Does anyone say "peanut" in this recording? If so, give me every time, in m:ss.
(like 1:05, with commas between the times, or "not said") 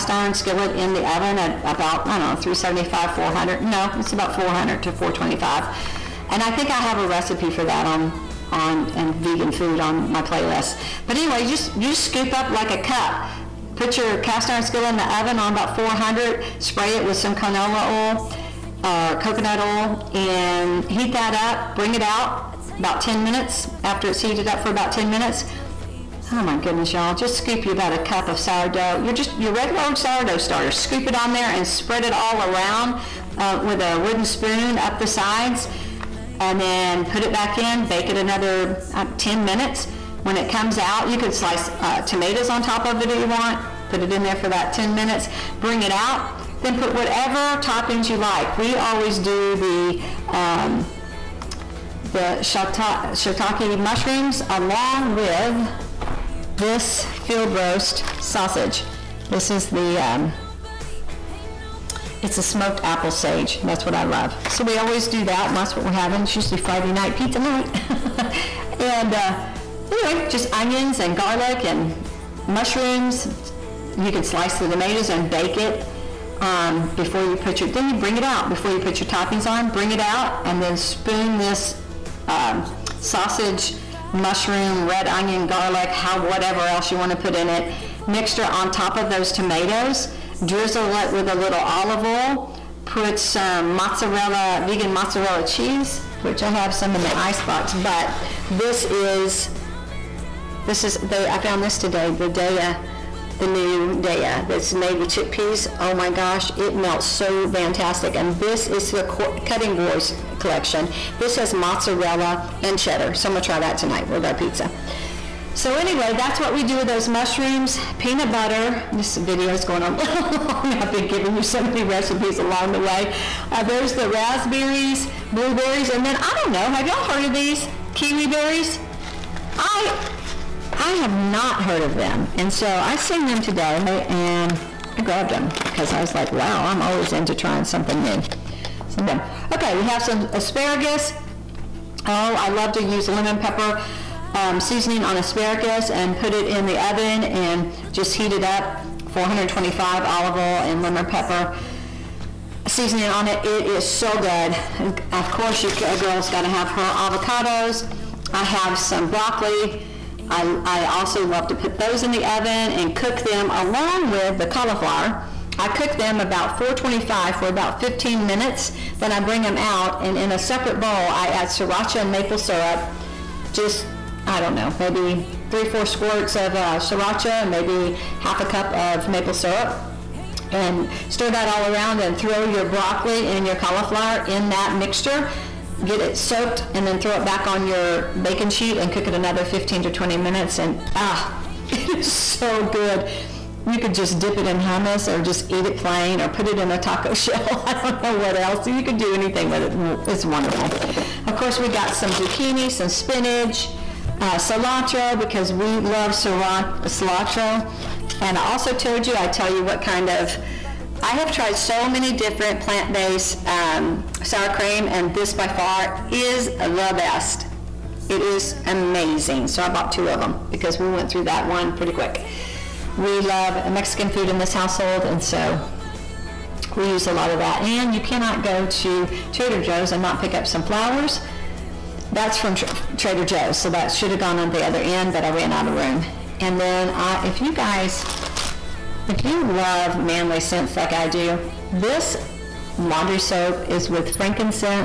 1:57.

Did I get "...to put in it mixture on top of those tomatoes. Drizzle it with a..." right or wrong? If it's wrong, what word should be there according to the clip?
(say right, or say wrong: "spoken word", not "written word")
right.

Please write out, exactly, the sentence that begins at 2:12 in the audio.
And so I seen them today and I grabbed them because I was like, wow, I'm always into trying something new.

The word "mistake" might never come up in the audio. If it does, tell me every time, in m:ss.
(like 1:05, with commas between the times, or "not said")
not said.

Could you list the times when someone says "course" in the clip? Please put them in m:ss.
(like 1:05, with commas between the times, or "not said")
2:35, 3:21.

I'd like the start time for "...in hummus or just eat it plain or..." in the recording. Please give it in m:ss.
3:14.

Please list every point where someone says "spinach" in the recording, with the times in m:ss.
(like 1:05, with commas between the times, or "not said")
3:22.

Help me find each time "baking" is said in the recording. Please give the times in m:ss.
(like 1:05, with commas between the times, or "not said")
3:08.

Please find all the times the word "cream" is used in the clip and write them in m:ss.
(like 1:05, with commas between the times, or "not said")
3:34.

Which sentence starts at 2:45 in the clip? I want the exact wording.
I cook them about 425 for about 15 minutes.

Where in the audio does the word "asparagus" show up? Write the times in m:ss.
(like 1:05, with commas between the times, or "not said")
2:20, 2:25.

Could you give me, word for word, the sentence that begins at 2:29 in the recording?
425 olive oil and lemon pepper seasoning on it.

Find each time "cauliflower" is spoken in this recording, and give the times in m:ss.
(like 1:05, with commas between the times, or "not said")
2:44, 3:03.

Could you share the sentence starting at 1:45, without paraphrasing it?
Oh my gosh, it melts so fantastic.